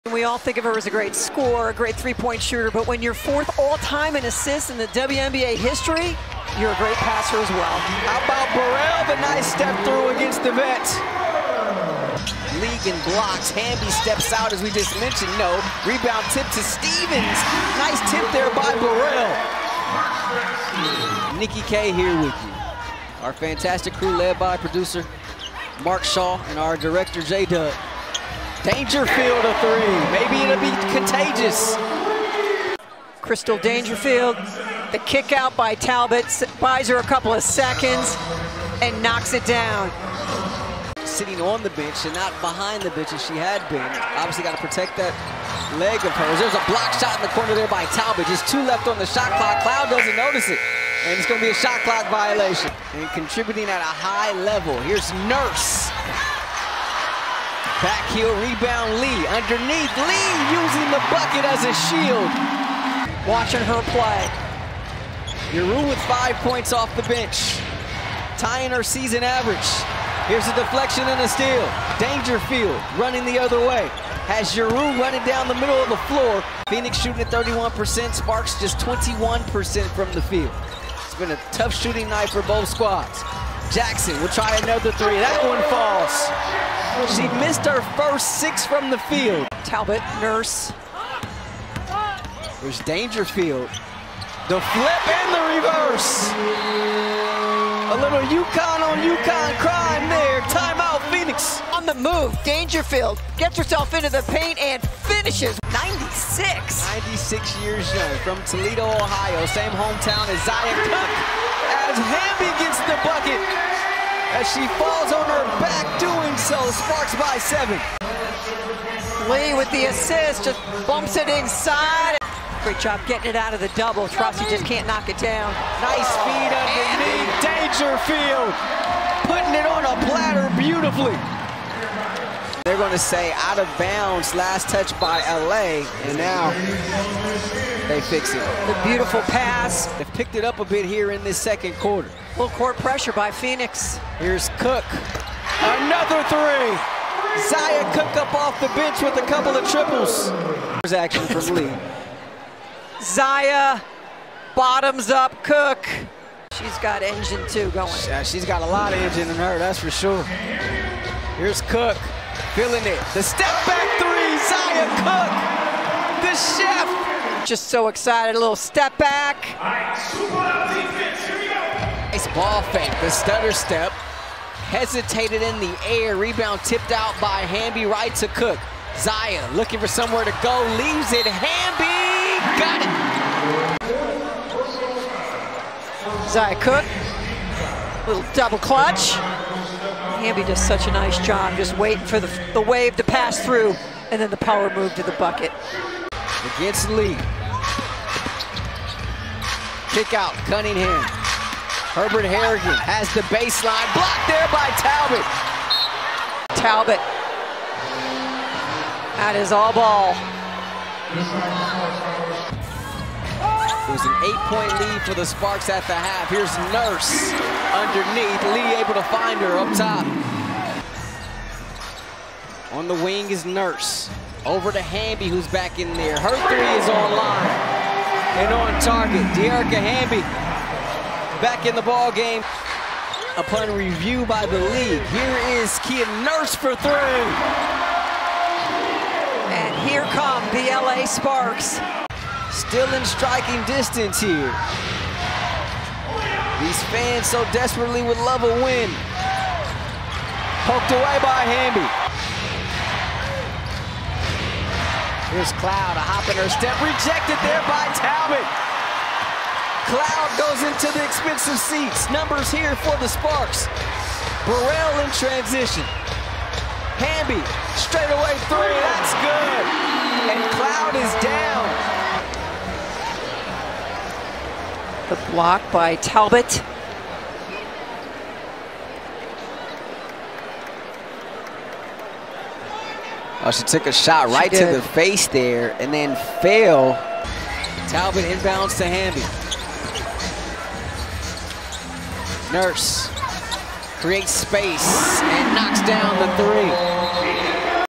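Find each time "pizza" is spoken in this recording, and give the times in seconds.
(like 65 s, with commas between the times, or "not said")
not said.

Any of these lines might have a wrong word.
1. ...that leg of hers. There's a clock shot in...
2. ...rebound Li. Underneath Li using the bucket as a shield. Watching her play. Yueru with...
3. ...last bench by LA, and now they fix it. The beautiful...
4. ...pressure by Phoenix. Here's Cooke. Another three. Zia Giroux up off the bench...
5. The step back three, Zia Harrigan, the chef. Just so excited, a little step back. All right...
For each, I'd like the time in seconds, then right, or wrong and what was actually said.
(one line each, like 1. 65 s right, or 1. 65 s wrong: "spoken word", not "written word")
1. 44 s wrong: "block", not "clock"
2. 58 s right
3. 134 s wrong: "touch", not "bench"
4. 142 s wrong: "Cooke", not "Giroux"
5. 163 s wrong: "Cooke", not "Harrigan".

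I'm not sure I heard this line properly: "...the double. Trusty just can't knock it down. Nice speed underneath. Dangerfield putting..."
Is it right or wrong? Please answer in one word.
right.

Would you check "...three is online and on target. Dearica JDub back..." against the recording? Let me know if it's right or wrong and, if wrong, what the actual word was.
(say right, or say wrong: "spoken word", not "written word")
wrong: "Hamby", not "JDub".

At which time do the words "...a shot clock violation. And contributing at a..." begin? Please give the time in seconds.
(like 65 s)
51 s.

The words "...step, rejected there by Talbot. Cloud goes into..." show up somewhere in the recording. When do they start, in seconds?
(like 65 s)
256 s.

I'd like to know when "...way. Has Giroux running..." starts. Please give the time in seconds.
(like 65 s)
73 s.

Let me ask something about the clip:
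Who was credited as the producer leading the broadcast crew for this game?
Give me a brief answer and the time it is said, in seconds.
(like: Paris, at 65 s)
Mark Shaw, at 25 s.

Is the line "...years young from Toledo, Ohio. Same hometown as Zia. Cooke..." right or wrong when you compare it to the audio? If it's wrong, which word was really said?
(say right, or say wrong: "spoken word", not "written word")
right.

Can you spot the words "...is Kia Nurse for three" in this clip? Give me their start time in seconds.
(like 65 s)
235 s.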